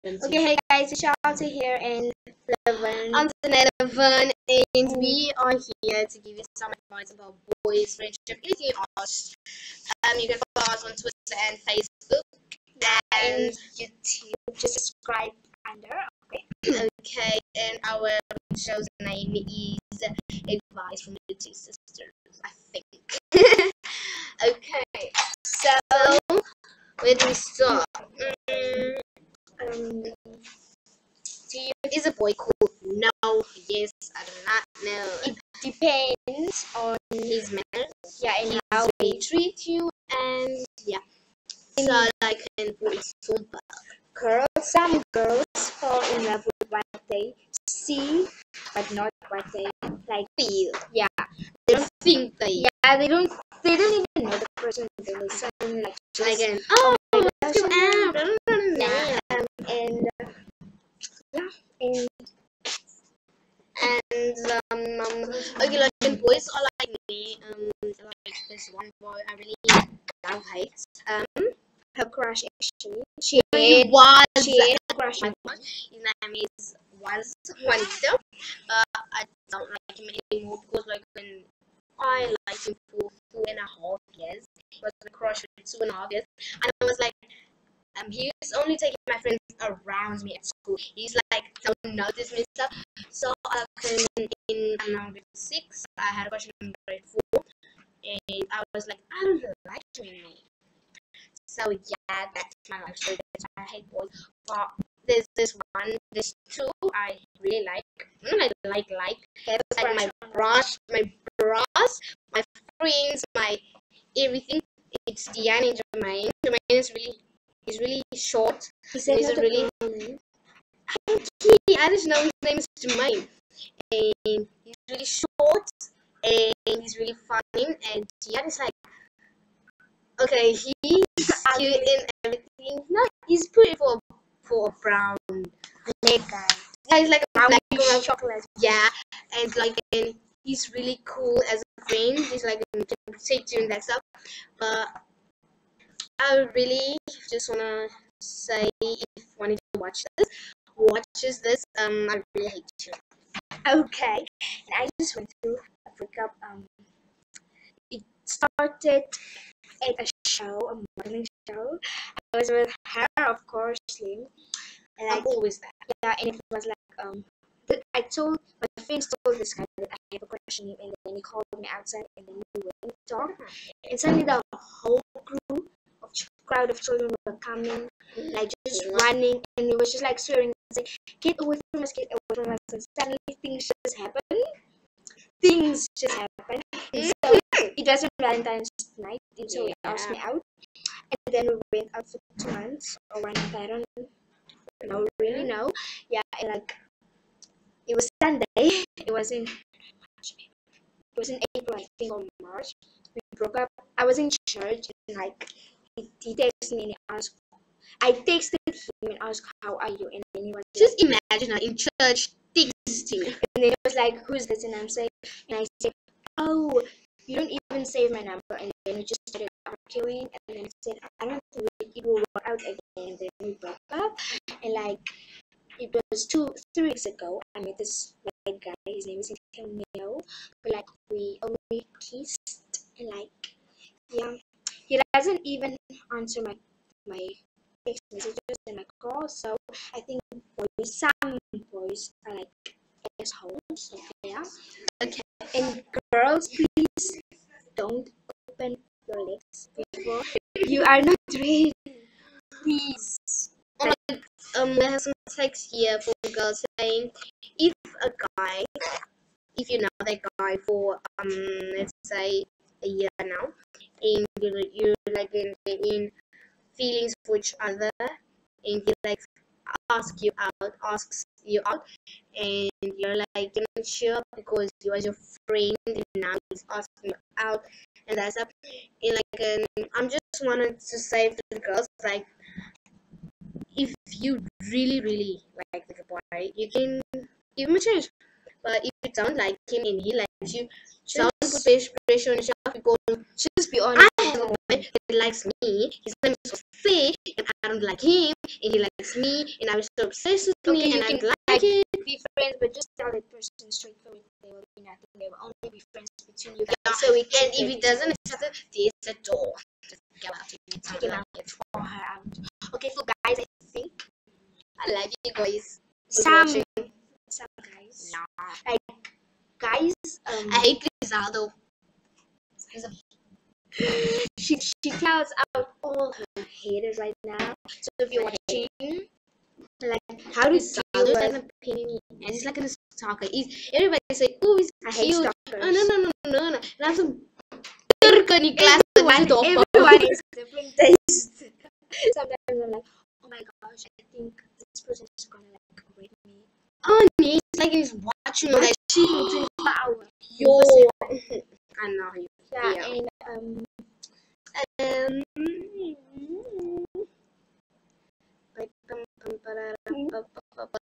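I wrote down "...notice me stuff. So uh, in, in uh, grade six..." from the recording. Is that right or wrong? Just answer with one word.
right.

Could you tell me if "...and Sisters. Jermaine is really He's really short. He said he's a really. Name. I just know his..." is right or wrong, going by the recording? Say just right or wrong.
wrong.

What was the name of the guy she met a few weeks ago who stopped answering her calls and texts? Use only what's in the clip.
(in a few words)
Neo.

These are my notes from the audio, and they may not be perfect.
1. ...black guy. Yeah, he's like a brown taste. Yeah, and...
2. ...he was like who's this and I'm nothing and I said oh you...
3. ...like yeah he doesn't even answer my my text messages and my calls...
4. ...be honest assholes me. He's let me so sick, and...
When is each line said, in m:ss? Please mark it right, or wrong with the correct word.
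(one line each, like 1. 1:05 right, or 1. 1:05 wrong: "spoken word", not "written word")
1. 2:15 wrong: "chocolate", not "taste"
2. 3:33 wrong: "saying", not "nothing"
3. 3:53 right
4. 4:53 wrong: "likes", not "assholes".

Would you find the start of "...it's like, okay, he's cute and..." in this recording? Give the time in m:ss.
2:08.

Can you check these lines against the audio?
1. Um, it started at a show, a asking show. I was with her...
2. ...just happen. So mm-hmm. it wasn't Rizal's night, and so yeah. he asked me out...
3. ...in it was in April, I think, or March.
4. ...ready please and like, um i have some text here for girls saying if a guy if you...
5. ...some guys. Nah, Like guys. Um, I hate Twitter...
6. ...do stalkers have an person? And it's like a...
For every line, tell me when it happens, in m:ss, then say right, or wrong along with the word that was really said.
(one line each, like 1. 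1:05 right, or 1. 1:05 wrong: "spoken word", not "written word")
1. 2:36 wrong: "morning", not "asking"
2. 3:05 wrong: "Valentine", not "Rizal"
3. 3:19 right
4. 4:11 right
5. 5:17 wrong: "Rizal", not "Twitter"
6. 5:30 wrong: "opinion", not "person".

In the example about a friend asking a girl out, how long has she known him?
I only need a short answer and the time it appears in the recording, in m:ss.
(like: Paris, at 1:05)
a year, at 4:22.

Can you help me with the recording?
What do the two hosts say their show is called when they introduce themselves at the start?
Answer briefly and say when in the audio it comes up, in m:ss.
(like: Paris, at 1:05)
Advice from the Two Sisters, at 0:20.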